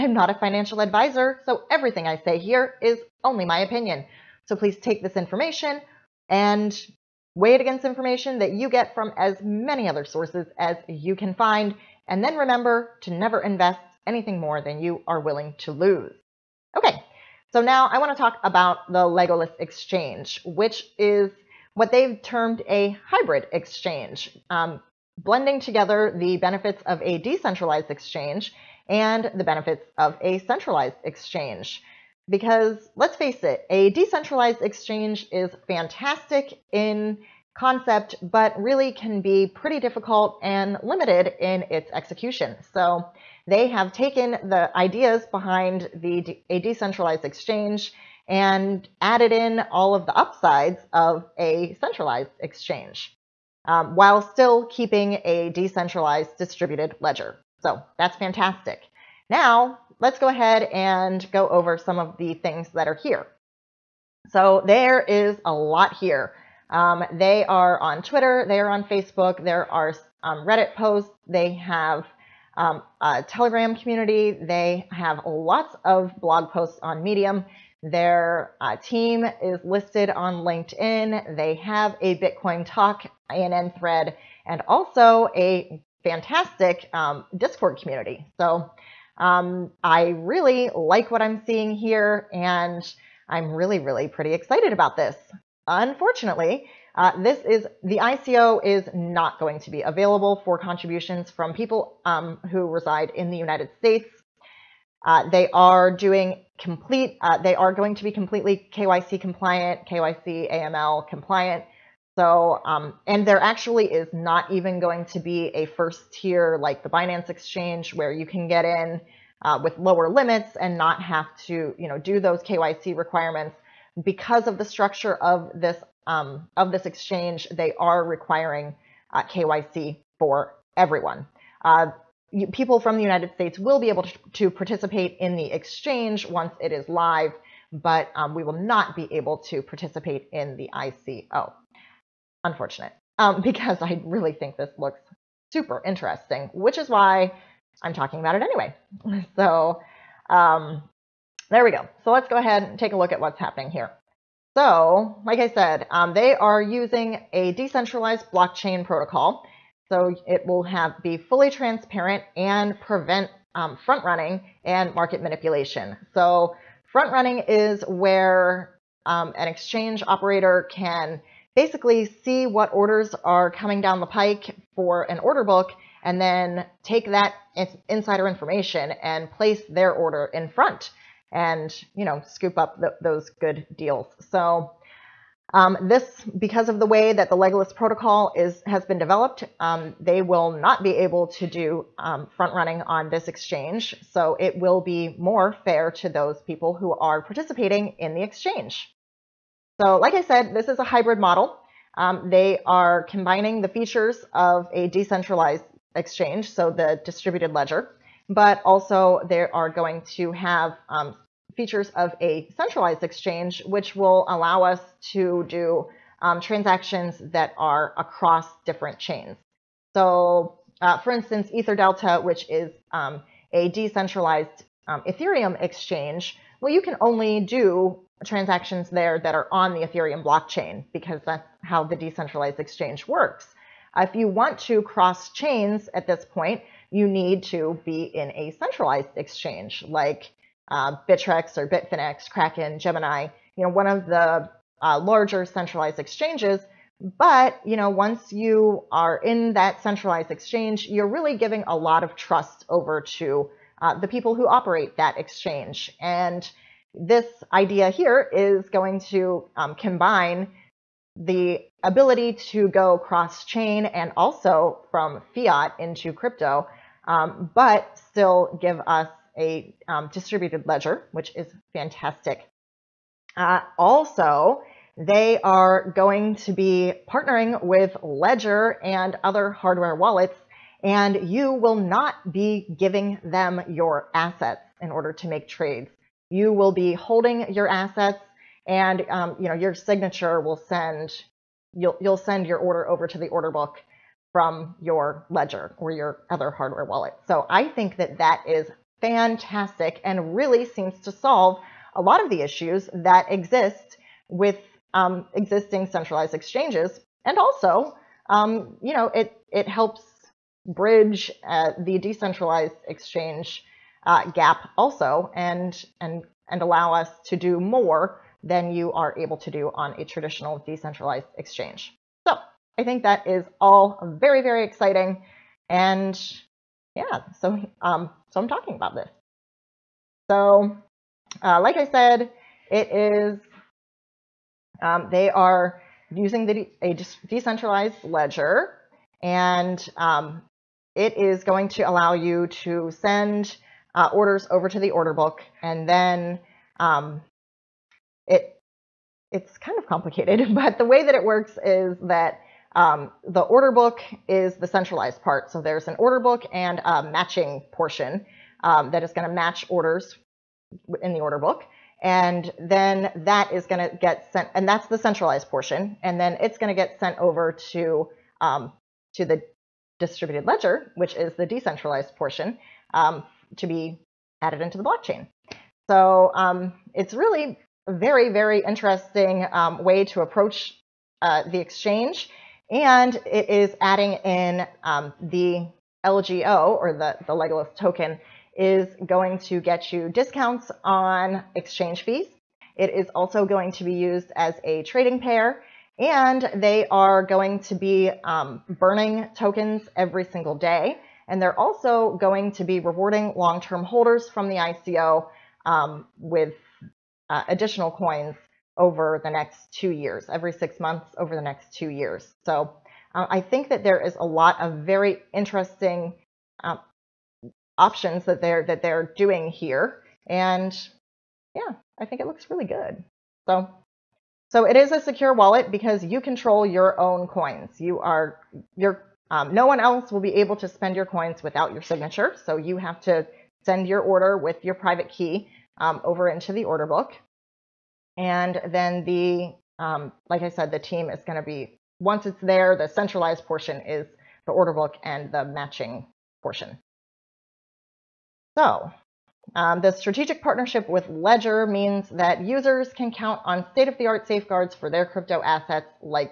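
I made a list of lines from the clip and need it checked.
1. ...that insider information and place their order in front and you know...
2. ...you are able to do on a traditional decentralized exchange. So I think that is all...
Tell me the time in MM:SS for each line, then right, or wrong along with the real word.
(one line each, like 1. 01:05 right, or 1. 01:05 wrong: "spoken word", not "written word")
1. 02:57 right
2. 05:18 right.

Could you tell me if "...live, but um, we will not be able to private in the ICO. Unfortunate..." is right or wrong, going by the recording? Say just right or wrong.
wrong.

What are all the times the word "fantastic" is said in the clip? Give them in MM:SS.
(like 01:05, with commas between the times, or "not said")
00:35, 00:58, 01:26, 04:31, 04:59.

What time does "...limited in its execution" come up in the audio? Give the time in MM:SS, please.
00:40.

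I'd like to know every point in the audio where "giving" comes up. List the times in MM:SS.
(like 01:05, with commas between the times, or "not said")
04:11, 04:42.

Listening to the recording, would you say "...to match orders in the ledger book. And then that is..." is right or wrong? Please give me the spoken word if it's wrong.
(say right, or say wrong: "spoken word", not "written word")
wrong: "order", not "ledger".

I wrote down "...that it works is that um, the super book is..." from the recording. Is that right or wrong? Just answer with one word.
wrong.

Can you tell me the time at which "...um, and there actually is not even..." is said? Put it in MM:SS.
01:52.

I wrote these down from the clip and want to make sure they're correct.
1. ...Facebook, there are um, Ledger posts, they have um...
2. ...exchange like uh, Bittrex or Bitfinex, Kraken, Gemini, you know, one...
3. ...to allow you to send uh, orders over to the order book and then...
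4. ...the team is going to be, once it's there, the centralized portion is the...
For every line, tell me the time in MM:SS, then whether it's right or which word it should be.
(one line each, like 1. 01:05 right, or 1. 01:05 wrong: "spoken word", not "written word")
1. 01:08 wrong: "Reddit", not "Ledger"
2. 03:59 right
3. 05:41 right
4. 07:20 right.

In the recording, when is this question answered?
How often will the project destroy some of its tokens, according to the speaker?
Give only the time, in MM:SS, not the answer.
06:39.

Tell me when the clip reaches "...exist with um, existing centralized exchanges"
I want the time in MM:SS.
05:03.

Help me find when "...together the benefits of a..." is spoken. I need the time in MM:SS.
00:25.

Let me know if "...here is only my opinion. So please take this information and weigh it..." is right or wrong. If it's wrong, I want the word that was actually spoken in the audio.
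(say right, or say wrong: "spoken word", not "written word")
right.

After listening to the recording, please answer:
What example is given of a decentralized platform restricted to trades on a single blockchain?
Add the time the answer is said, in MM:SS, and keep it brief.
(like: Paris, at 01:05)
Ether Delta, at 03:41.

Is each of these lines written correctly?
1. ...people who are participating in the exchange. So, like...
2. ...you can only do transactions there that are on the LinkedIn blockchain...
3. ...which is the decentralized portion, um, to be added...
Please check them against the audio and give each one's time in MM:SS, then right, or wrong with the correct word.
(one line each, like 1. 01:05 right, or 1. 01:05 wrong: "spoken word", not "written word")
1. 03:16 right
2. 03:46 wrong: "Ethereum", not "LinkedIn"
3. 06:10 right.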